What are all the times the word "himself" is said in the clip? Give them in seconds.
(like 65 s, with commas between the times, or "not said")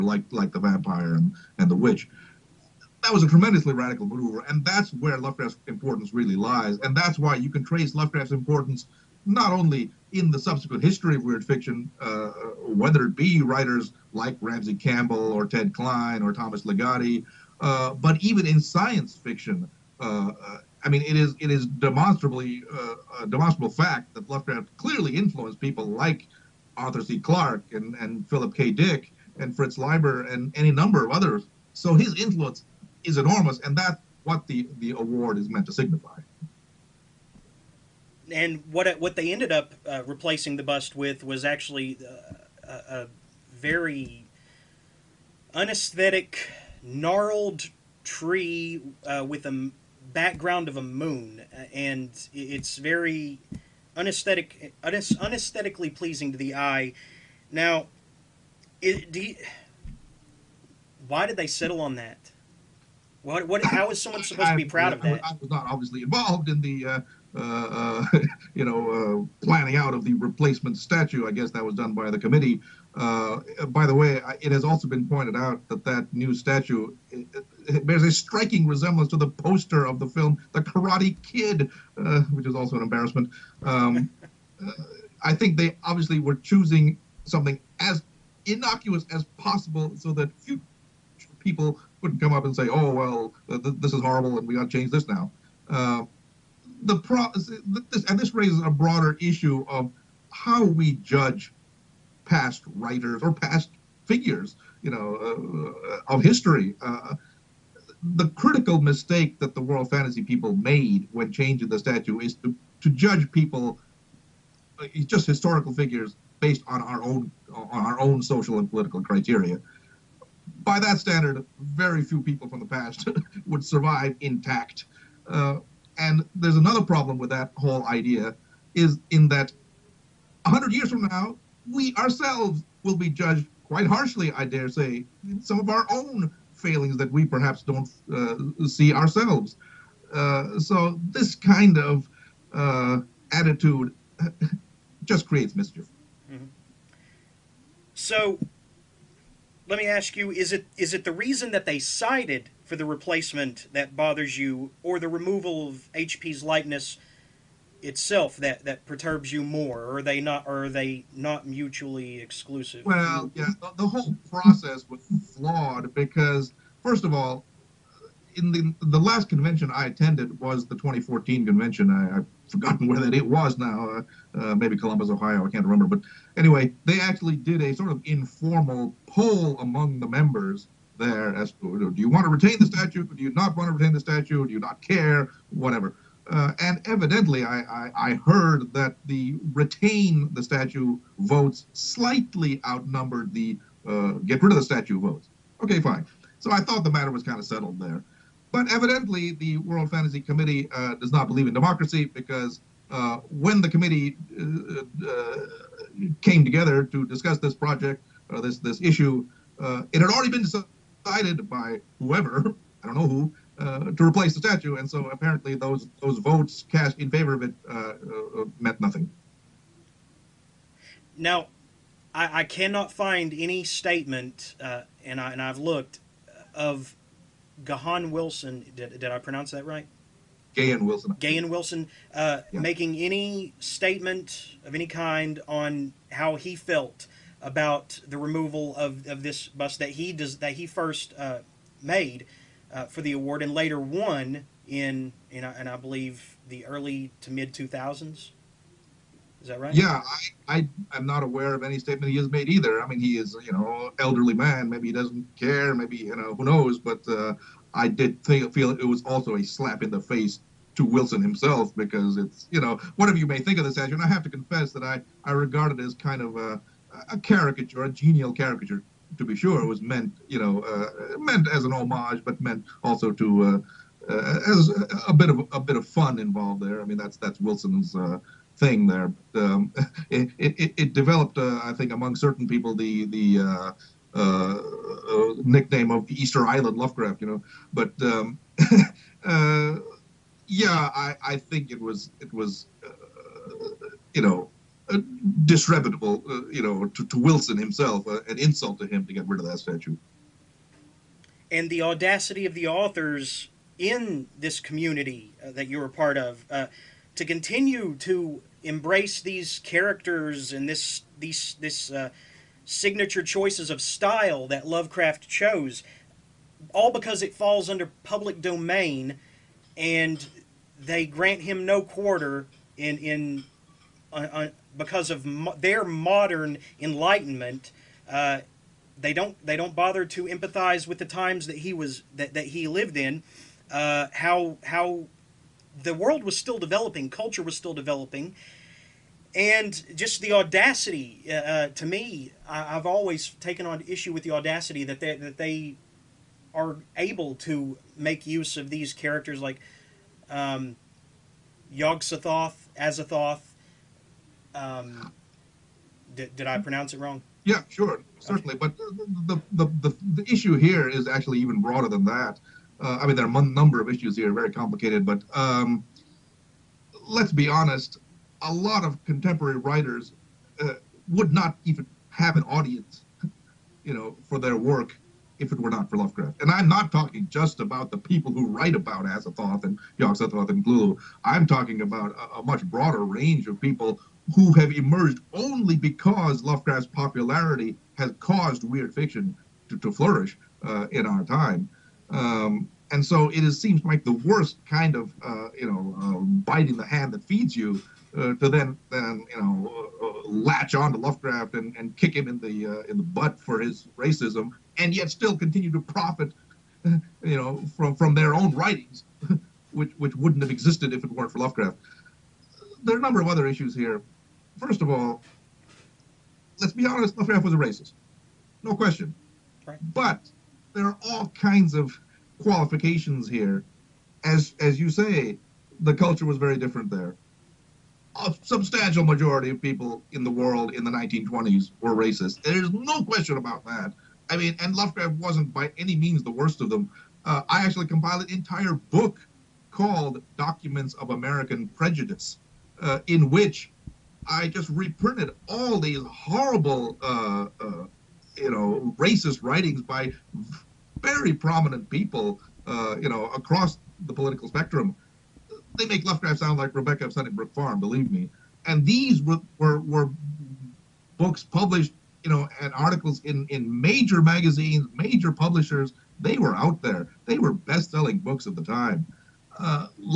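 261 s, 297 s.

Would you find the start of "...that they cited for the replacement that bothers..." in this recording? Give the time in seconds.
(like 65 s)
151 s.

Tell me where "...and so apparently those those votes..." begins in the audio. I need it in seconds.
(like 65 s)
214 s.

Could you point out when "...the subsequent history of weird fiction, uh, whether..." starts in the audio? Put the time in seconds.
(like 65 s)
10 s.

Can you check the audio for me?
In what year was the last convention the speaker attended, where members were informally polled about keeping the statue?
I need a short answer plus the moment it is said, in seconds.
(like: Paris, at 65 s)
2014, at 170 s.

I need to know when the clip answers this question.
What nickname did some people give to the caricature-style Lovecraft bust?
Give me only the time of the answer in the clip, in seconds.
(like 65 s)
286 s.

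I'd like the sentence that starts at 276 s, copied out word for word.
I mean, that's that's Wilson's uh, thing there.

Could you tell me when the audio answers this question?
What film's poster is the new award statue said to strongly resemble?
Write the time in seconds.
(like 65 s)
80 s.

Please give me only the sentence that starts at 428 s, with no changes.
A substantial majority of people in the world in the 1920s were racist.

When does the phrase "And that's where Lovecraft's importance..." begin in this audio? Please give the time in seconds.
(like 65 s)
4 s.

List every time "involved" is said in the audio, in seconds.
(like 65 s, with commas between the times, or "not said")
66 s, 276 s.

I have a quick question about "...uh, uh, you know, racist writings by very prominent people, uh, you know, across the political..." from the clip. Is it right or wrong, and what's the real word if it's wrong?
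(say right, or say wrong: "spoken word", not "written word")
right.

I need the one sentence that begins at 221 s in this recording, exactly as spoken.
Now, I, I cannot find any statement, uh, and I and I've looked of Gahan Wilson.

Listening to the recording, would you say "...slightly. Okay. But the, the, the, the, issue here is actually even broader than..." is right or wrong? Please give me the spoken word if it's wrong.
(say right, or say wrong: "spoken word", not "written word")
wrong: "certainly", not "slightly".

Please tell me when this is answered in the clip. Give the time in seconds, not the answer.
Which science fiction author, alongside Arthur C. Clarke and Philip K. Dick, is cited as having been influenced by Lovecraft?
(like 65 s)
29 s.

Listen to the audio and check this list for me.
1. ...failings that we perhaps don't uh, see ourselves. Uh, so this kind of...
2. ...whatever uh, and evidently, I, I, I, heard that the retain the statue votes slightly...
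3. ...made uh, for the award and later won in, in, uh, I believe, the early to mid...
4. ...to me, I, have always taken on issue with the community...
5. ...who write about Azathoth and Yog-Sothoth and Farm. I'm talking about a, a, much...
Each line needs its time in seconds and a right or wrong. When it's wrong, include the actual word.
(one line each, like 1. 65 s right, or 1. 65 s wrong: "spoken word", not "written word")
1. 136 s right
2. 185 s right
3. 241 s right
4. 341 s wrong: "audacity", not "community"
5. 378 s wrong: "Cthulhu", not "Farm".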